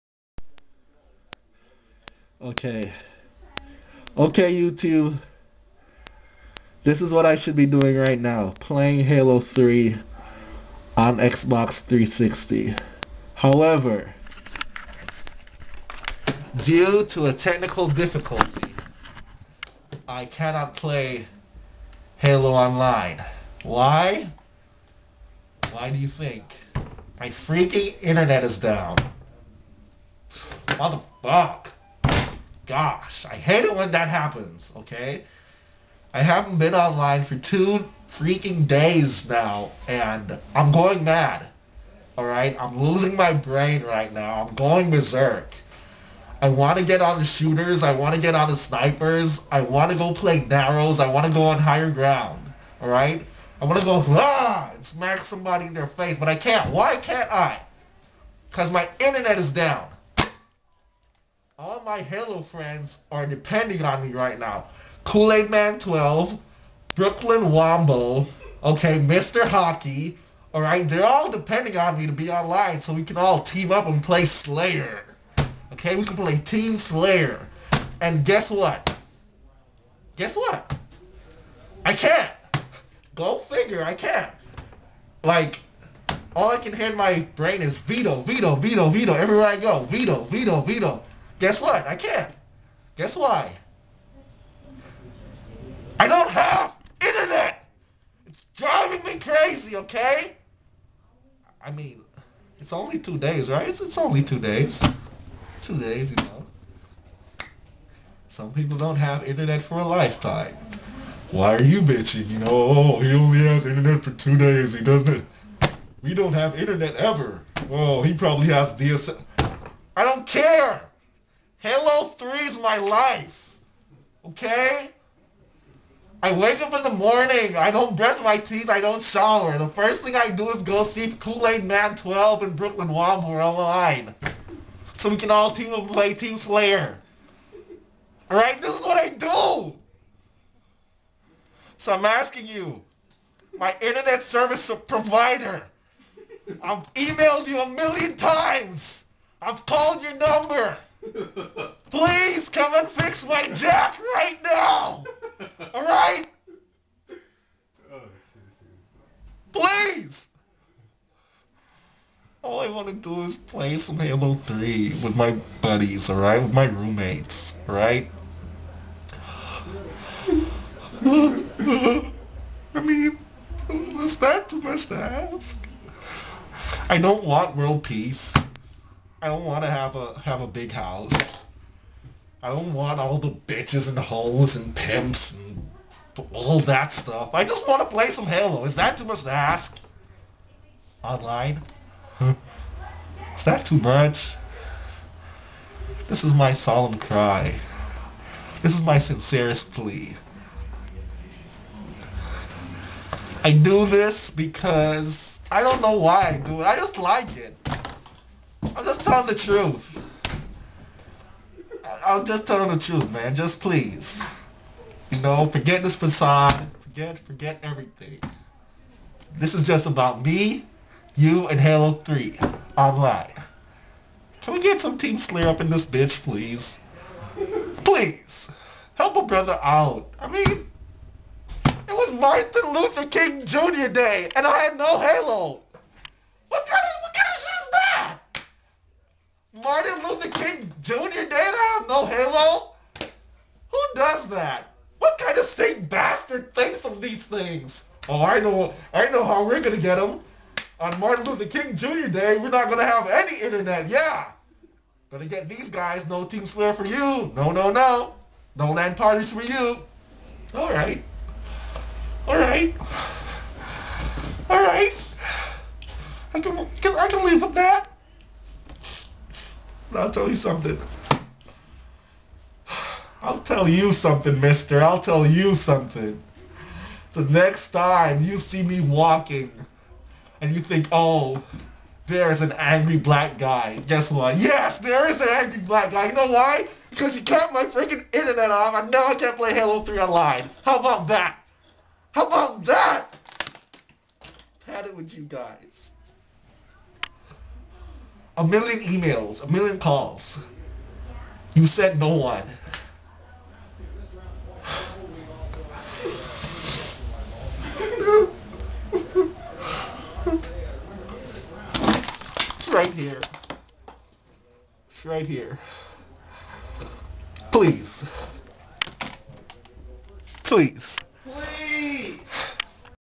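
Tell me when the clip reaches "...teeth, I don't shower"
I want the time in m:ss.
2:08.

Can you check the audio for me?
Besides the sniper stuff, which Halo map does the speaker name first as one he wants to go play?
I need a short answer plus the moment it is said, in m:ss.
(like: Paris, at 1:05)
Narrows, at 0:50.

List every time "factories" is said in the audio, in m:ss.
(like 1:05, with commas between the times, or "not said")
not said.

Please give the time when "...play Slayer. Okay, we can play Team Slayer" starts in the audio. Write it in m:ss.
1:14.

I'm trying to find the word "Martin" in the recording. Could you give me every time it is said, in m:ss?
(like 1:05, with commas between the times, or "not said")
3:52, 3:59, 4:11.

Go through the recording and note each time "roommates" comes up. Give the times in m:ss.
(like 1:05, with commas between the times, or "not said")
2:46.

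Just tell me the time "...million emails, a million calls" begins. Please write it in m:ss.
4:58.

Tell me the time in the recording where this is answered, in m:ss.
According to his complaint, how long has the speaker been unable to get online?
0:37.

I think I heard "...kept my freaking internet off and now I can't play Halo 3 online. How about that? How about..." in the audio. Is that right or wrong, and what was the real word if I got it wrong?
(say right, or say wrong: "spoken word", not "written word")
right.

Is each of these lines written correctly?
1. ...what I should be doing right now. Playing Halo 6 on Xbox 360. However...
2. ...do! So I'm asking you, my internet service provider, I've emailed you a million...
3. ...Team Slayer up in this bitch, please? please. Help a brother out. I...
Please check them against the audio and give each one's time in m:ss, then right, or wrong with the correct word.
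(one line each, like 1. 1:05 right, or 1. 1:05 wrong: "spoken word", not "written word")
1. 0:07 wrong: "3", not "6"
2. 2:19 right
3. 3:44 right.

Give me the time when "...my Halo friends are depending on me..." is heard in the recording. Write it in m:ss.
1:01.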